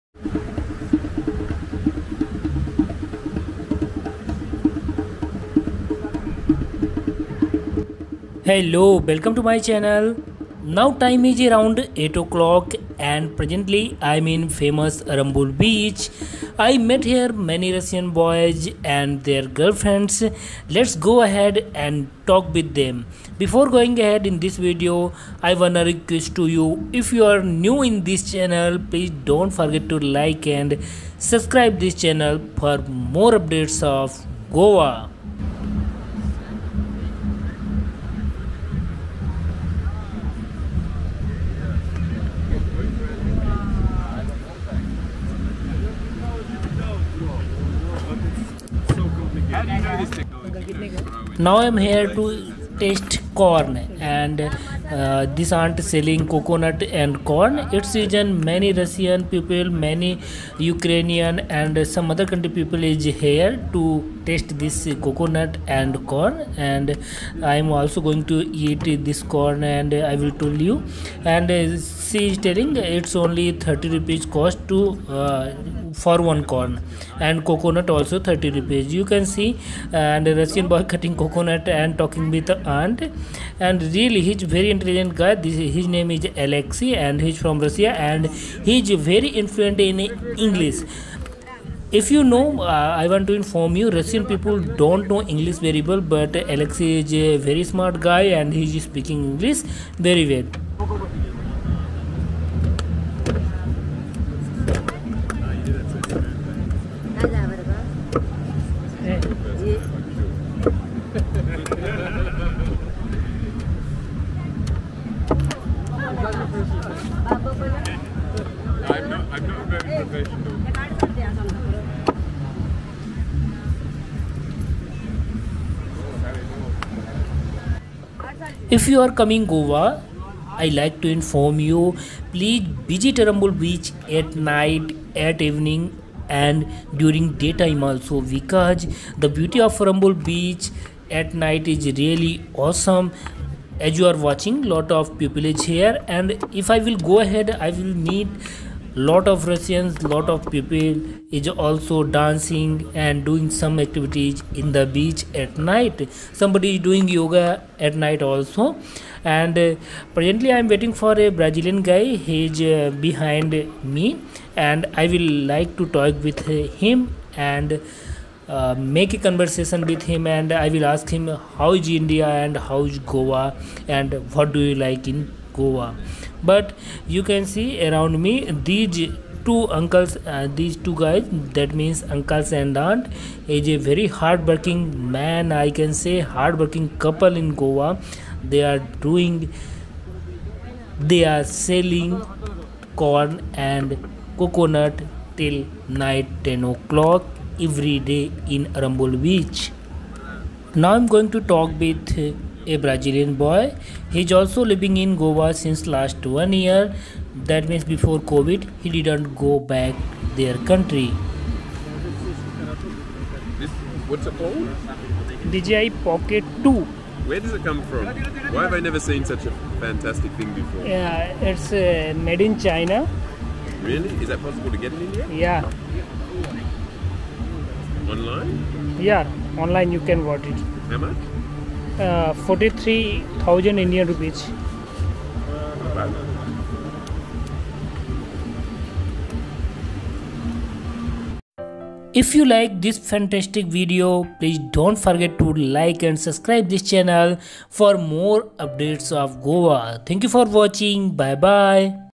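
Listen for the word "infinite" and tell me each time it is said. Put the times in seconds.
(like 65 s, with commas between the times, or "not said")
not said.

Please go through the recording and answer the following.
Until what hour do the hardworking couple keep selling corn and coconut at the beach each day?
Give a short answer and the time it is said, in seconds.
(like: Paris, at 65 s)
10 o'clock, at 195 s.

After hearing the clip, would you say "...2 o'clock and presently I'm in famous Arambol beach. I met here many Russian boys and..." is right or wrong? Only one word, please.
wrong.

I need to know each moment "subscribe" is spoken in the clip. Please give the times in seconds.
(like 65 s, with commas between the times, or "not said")
31 s, 246 s.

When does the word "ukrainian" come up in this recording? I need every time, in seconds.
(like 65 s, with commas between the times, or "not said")
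60 s.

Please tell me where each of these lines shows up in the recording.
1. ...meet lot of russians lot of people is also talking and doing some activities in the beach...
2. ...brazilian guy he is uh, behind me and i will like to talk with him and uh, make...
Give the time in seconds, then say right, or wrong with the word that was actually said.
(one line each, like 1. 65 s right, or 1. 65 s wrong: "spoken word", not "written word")
1. 148 s wrong: "dancing", not "talking"
2. 161 s right.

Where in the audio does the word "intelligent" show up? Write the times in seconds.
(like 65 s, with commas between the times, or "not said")
84 s.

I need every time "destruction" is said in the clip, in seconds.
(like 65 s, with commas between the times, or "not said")
not said.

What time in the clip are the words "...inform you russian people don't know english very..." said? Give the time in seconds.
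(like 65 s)
93 s.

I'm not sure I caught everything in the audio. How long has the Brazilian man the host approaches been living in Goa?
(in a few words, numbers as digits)
one year.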